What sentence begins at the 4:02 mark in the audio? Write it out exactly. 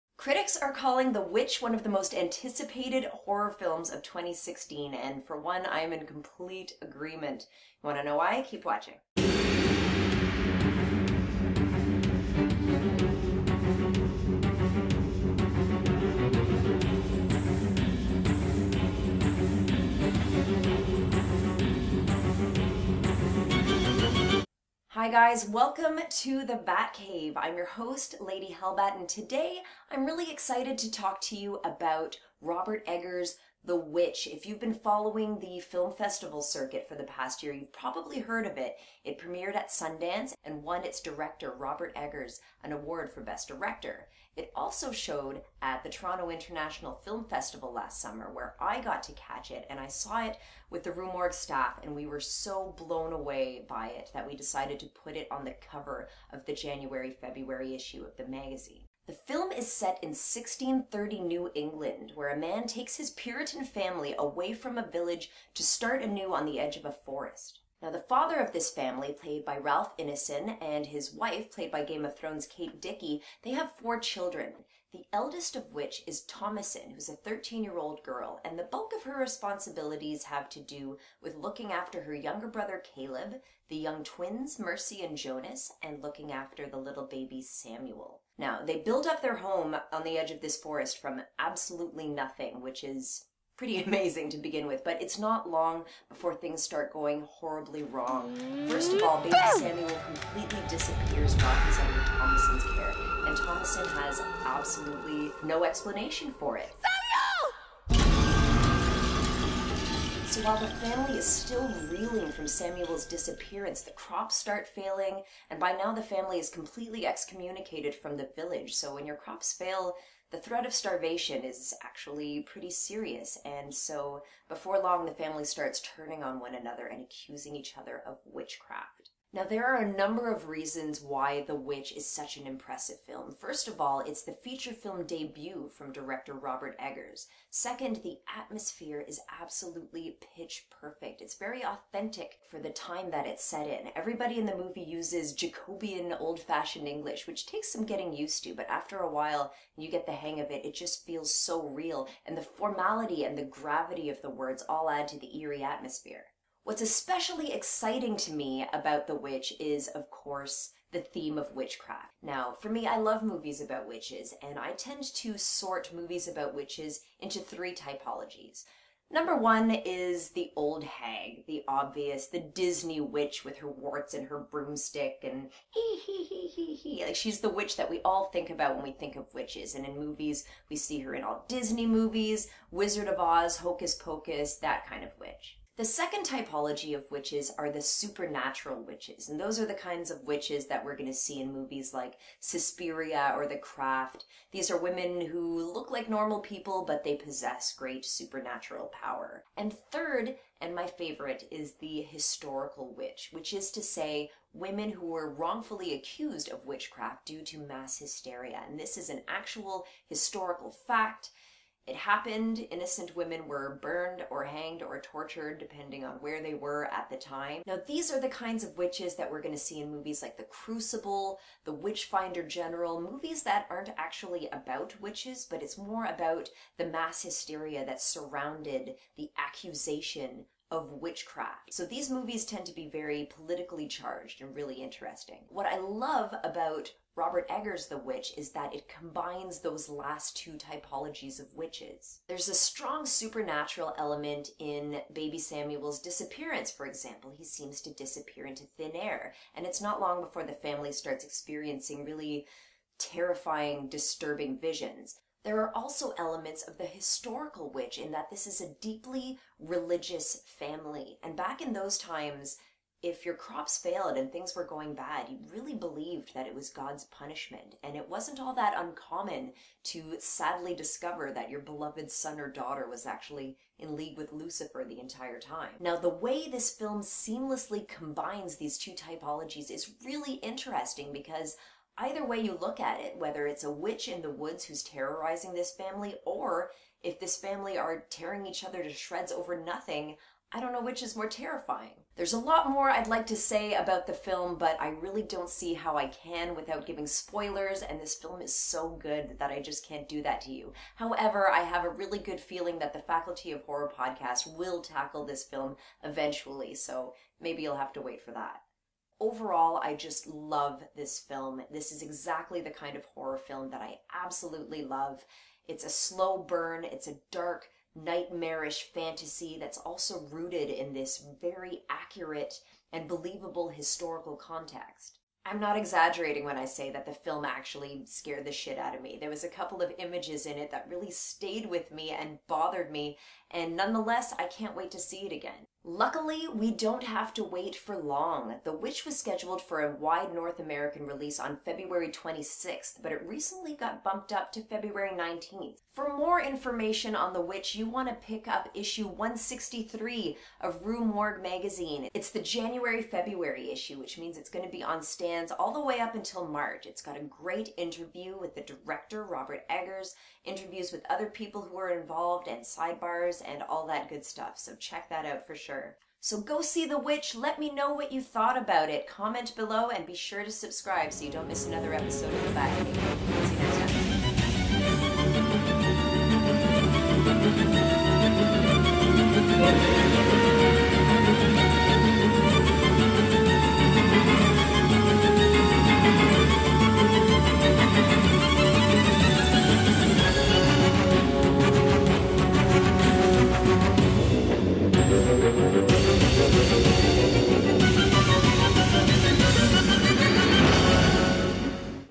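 There's a strong supernatural element in Baby Samuel's disappearance, for example.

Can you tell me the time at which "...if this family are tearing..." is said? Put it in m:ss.
4:47.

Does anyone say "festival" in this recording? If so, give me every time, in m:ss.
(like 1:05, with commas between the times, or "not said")
0:35, 0:47.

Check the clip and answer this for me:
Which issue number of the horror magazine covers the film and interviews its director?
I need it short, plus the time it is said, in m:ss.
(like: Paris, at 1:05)
163, at 5:49.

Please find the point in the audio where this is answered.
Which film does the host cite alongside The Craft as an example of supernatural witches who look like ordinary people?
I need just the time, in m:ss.
3:12.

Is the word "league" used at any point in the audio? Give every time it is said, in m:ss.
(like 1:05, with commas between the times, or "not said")
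4:33.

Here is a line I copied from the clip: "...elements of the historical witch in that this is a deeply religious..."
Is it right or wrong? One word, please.
right.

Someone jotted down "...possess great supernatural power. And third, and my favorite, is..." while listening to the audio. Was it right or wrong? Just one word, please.
right.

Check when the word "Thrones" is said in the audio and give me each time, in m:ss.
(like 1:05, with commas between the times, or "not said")
1:12.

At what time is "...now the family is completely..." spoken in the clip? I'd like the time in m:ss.
1:55.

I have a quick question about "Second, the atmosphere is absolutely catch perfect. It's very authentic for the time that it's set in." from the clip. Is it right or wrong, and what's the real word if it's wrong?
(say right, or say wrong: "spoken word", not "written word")
wrong: "pitch", not "catch".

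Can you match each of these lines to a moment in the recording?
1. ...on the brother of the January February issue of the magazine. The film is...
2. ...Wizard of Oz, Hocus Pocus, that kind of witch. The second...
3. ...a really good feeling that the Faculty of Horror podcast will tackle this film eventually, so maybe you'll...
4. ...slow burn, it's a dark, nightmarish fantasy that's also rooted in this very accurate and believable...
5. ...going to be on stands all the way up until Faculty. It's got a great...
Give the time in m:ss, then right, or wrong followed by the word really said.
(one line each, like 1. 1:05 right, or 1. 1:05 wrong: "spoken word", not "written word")
1. 0:55 wrong: "cover", not "brother"
2. 3:02 right
3. 5:01 right
4. 5:15 right
5. 5:54 wrong: "March", not "Faculty".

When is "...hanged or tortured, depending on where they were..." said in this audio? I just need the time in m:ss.
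3:34.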